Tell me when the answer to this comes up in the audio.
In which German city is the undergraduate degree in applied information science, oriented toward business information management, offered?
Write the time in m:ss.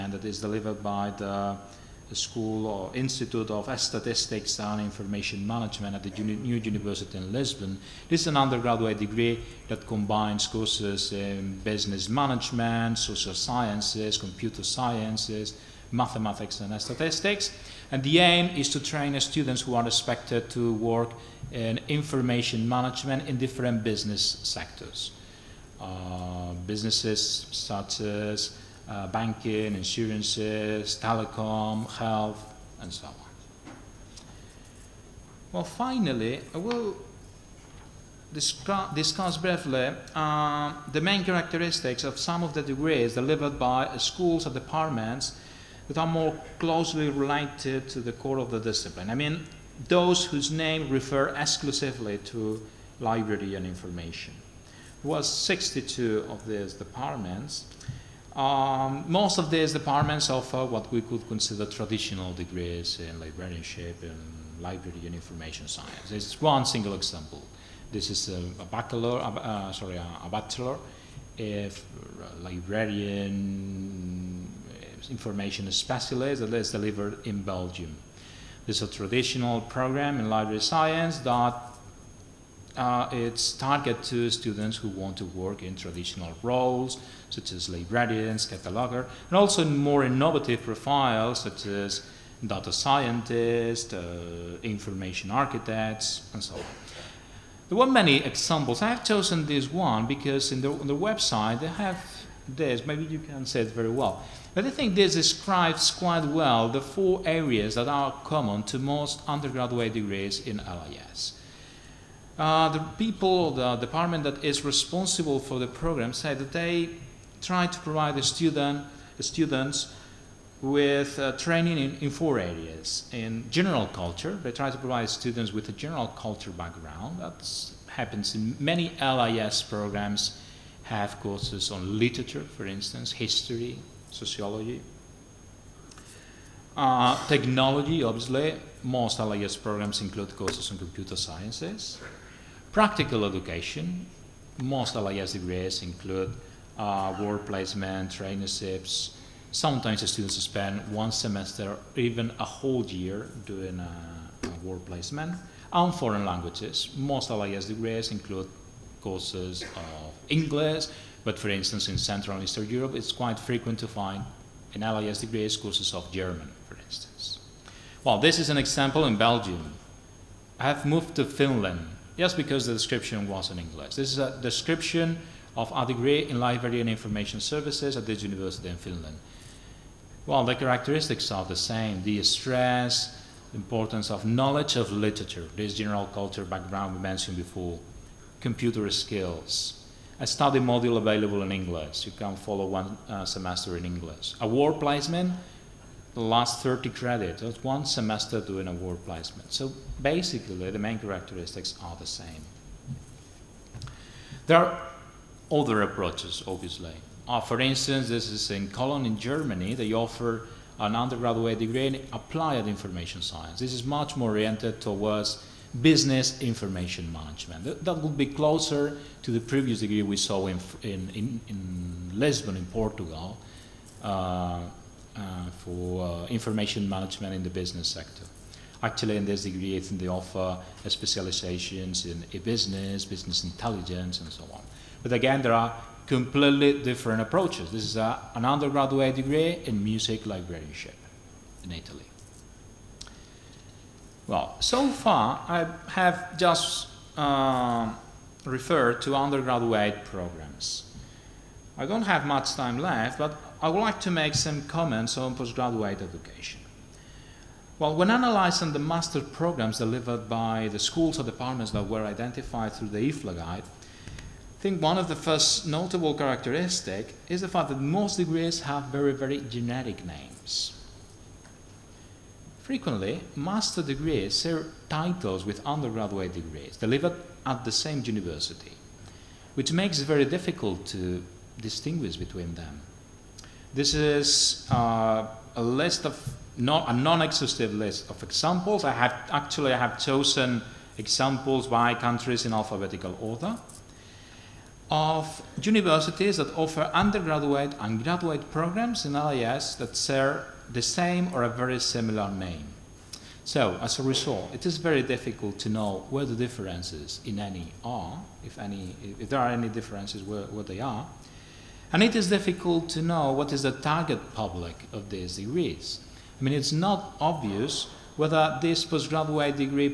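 3:28.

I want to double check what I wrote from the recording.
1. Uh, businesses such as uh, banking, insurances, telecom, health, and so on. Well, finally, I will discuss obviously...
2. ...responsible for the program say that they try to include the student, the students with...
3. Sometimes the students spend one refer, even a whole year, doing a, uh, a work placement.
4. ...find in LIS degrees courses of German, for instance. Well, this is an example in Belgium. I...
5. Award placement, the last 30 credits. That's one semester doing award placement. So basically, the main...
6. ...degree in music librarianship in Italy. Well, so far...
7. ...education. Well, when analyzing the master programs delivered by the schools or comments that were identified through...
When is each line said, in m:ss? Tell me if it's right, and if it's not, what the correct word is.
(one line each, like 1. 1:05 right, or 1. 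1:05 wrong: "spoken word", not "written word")
1. 0:25 wrong: "briefly", not "obviously"
2. 1:54 wrong: "provide", not "include"
3. 2:29 wrong: "semester", not "refer"
4. 2:43 right
5. 3:14 right
6. 3:59 right
7. 4:16 wrong: "departments", not "comments".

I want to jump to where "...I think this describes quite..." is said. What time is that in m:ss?
1:44.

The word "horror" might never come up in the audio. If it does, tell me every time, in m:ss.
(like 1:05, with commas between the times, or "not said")
not said.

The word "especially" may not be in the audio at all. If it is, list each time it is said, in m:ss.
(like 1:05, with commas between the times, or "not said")
1:15.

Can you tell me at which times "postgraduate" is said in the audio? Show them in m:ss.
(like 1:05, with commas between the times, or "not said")
4:15, 5:18.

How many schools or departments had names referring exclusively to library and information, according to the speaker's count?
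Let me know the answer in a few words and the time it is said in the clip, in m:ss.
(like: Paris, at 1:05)
62, at 0:55.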